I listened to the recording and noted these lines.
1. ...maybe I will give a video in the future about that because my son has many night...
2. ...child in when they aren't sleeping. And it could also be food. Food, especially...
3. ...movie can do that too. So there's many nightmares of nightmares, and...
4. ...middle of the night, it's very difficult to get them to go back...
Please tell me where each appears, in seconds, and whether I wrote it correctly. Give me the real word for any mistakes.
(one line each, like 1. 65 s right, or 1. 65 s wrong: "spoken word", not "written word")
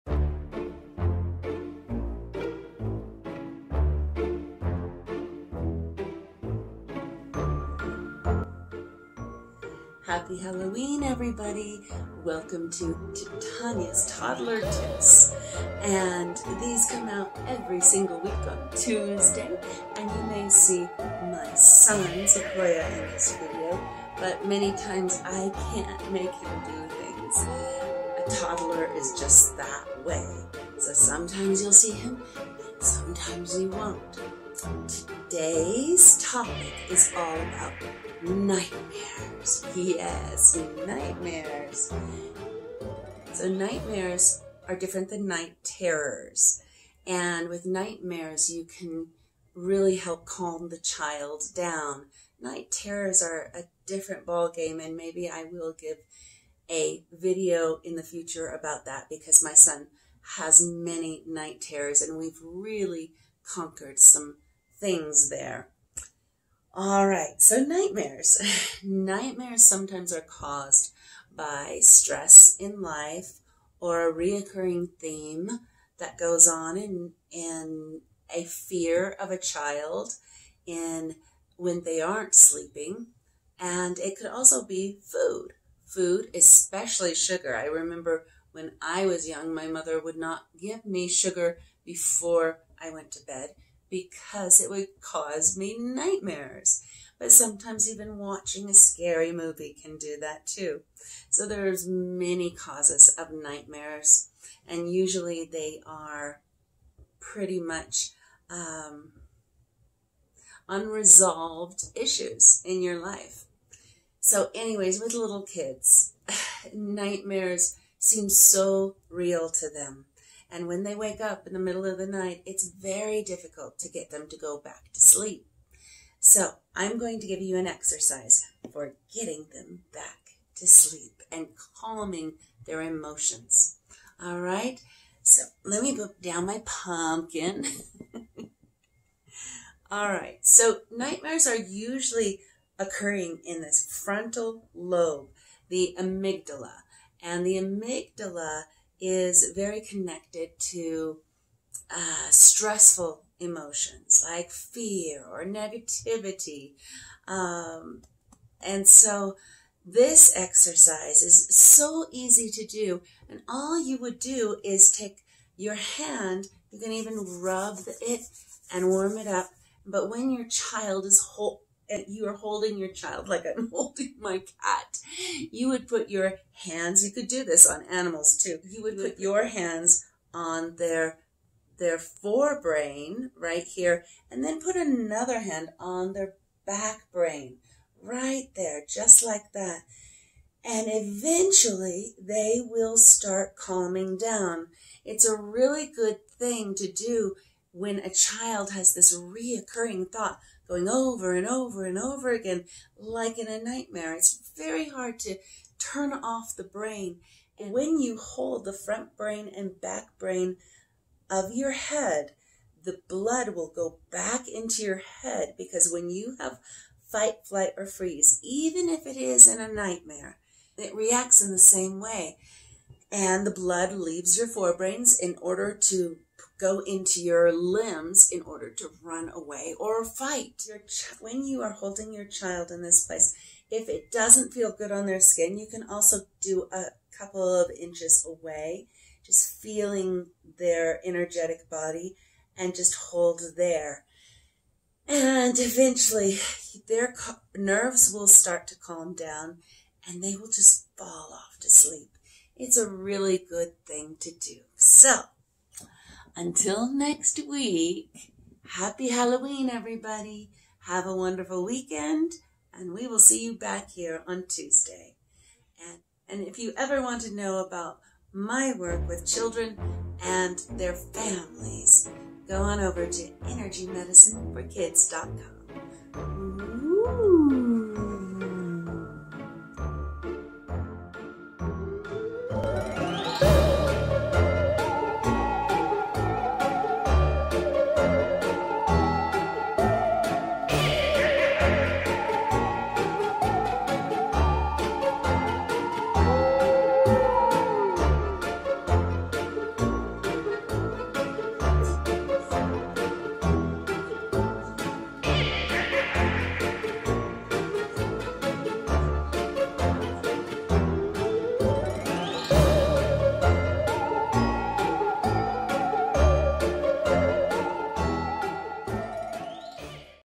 1. 54 s right
2. 79 s right
3. 99 s wrong: "causes", not "nightmares"
4. 121 s right.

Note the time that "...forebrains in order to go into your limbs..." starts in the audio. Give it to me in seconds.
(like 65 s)
224 s.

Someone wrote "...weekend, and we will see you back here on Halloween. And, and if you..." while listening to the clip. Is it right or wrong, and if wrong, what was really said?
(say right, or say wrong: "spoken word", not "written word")
wrong: "Tuesday", not "Halloween".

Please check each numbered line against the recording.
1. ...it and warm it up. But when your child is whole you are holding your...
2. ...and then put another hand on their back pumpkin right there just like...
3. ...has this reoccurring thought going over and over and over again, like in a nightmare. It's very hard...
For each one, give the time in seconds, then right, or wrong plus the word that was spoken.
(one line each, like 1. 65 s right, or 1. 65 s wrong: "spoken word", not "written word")
1. 168 s right
2. 184 s wrong: "brain", not "pumpkin"
3. 198 s right.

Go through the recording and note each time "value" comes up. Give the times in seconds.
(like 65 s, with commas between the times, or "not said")
not said.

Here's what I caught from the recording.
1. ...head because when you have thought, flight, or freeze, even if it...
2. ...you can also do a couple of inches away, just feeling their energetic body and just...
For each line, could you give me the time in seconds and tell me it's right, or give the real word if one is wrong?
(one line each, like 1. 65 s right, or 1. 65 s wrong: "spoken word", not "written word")
1. 215 s wrong: "fight", not "thought"
2. 235 s right.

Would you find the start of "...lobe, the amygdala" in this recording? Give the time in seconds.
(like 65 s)
144 s.